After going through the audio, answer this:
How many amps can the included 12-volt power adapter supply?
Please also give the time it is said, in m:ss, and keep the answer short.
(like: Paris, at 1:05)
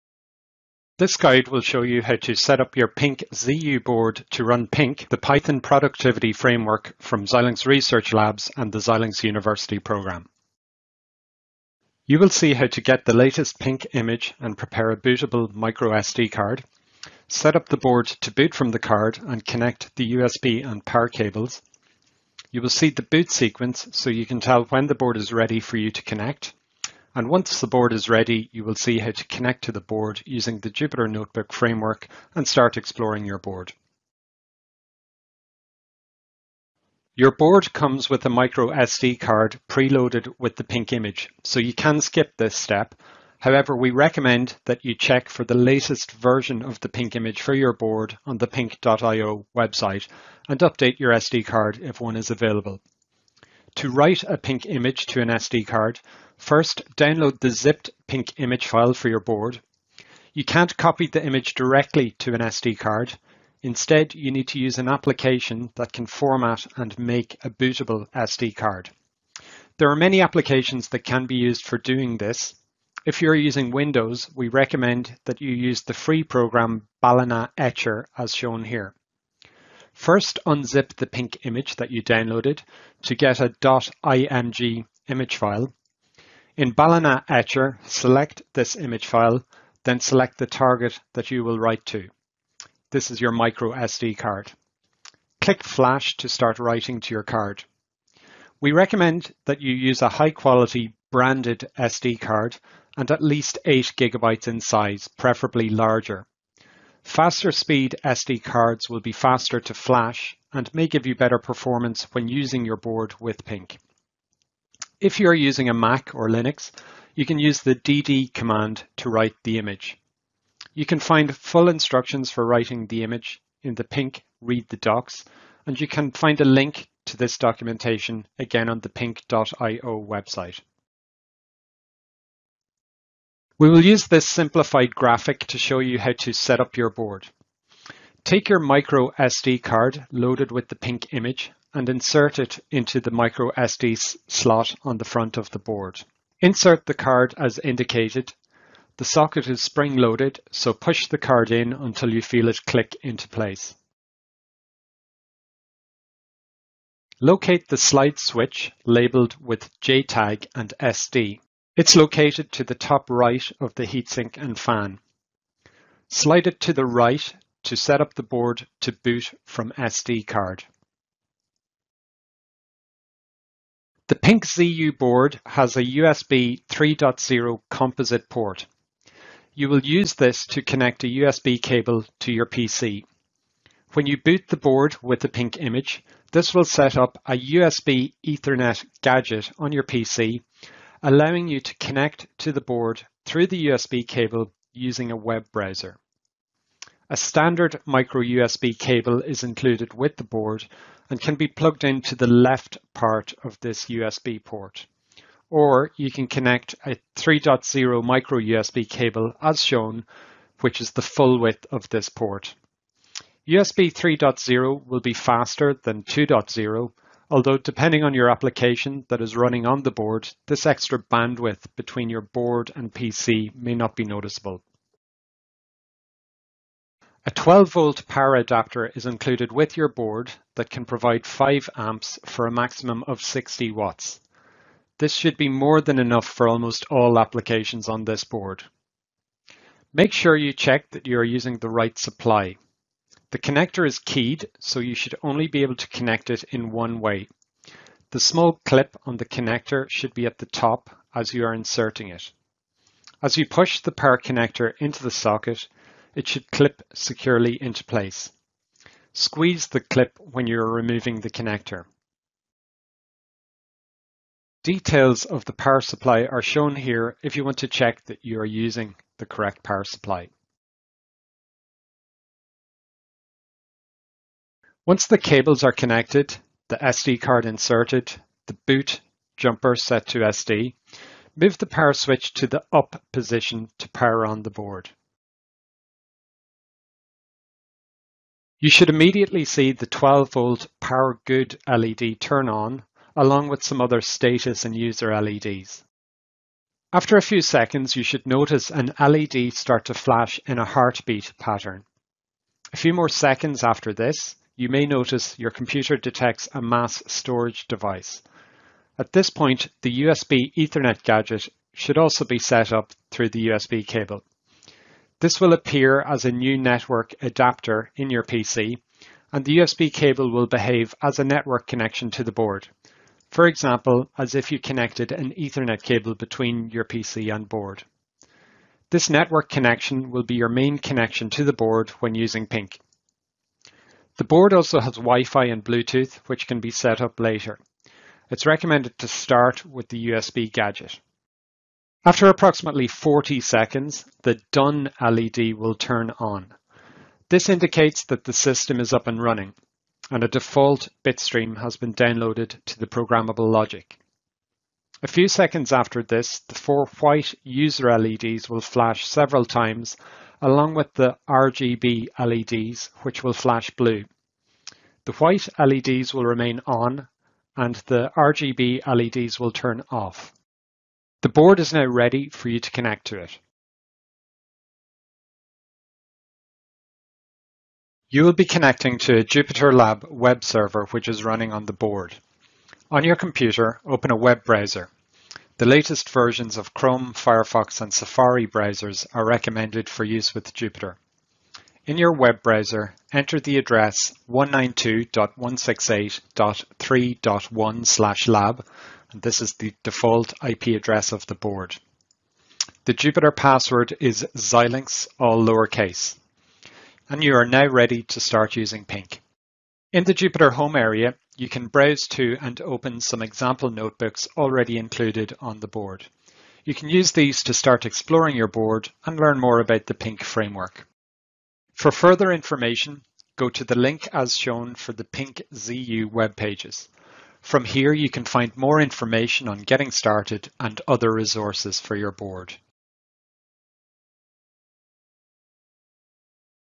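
5 amps, at 3:51.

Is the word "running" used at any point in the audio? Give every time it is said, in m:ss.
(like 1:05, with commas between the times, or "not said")
3:39, 5:49, 6:21.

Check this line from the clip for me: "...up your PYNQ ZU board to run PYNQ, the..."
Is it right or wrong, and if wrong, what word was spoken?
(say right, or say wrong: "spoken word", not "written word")
right.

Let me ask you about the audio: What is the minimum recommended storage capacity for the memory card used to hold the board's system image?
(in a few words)
8 gigabytes.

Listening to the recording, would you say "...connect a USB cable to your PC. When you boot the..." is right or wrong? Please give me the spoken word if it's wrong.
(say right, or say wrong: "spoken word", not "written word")
right.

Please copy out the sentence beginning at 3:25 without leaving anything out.
Or you can connect a 3.0 micro USB cable as shown, which is the full width of this port.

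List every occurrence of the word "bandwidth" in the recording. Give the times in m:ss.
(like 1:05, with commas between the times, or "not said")
3:41.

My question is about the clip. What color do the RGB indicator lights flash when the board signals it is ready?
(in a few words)
blue.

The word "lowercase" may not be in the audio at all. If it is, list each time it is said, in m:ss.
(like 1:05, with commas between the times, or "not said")
6:45.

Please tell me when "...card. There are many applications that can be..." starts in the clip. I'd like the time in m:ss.
1:08.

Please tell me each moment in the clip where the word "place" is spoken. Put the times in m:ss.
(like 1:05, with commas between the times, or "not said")
2:33, 4:17.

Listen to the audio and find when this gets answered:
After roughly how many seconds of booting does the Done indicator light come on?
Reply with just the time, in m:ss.
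5:42.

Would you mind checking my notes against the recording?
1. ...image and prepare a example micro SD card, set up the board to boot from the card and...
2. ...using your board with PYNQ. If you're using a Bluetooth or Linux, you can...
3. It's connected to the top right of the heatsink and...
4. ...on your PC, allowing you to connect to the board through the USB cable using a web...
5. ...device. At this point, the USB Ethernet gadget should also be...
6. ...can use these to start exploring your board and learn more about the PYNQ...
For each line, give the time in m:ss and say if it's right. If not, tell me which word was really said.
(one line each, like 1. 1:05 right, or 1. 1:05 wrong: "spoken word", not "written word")
1. 0:13 wrong: "bootable", not "example"
2. 1:52 wrong: "Mac", not "Bluetooth"
3. 2:41 wrong: "located", not "connected"
4. 3:09 right
5. 5:07 right
6. 6:56 right.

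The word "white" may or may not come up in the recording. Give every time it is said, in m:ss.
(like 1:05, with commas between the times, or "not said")
5:57, 6:05.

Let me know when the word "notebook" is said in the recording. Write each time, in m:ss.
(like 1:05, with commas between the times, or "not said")
0:31, 6:53.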